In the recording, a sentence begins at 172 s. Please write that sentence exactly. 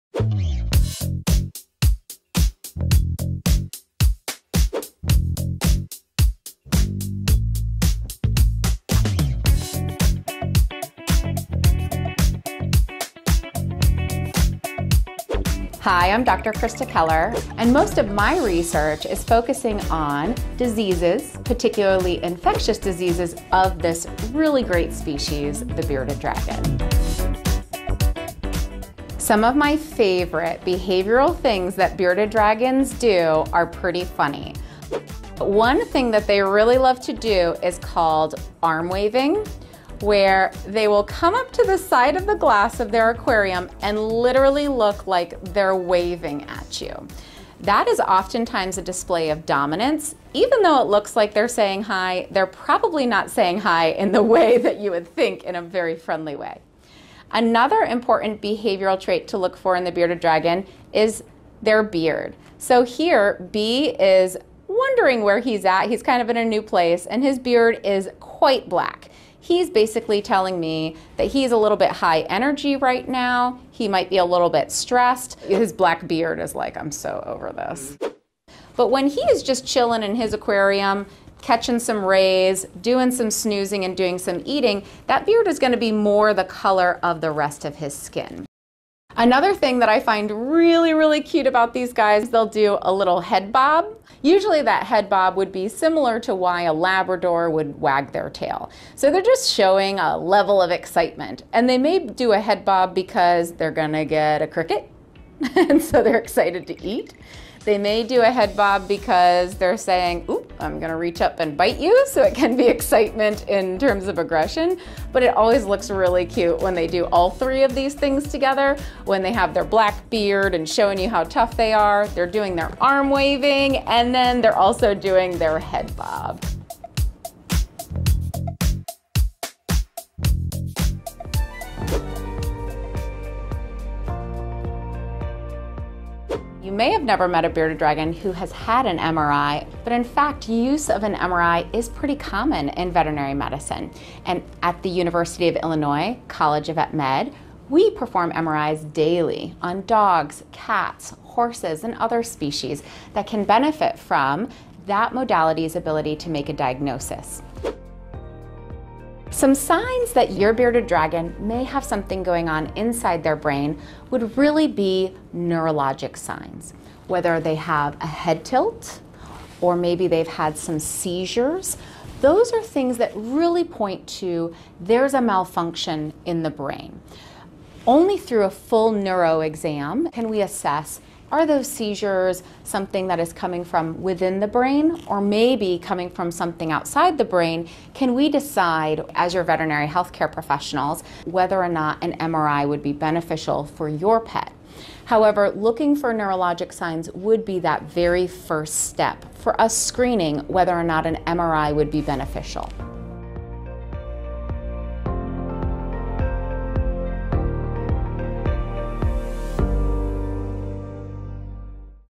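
Those are things that really point to there's a malfunction in the brain.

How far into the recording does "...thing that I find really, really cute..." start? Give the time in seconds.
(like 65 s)
89 s.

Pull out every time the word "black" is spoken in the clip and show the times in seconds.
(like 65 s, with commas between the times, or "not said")
68 s, 75 s, 119 s.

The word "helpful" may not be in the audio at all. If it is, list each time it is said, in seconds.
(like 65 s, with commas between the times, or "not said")
not said.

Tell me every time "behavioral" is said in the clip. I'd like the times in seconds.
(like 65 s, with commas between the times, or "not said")
30 s, 58 s.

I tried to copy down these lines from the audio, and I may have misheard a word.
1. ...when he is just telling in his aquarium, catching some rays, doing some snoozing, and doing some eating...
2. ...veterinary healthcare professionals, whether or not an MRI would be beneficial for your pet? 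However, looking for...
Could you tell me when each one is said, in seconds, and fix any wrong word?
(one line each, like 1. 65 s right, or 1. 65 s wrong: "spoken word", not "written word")
1. 78 s wrong: "chilling", not "telling"
2. 189 s right.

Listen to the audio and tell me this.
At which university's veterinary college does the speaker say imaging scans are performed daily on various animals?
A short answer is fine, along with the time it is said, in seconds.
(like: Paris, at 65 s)
University of Illinois, at 144 s.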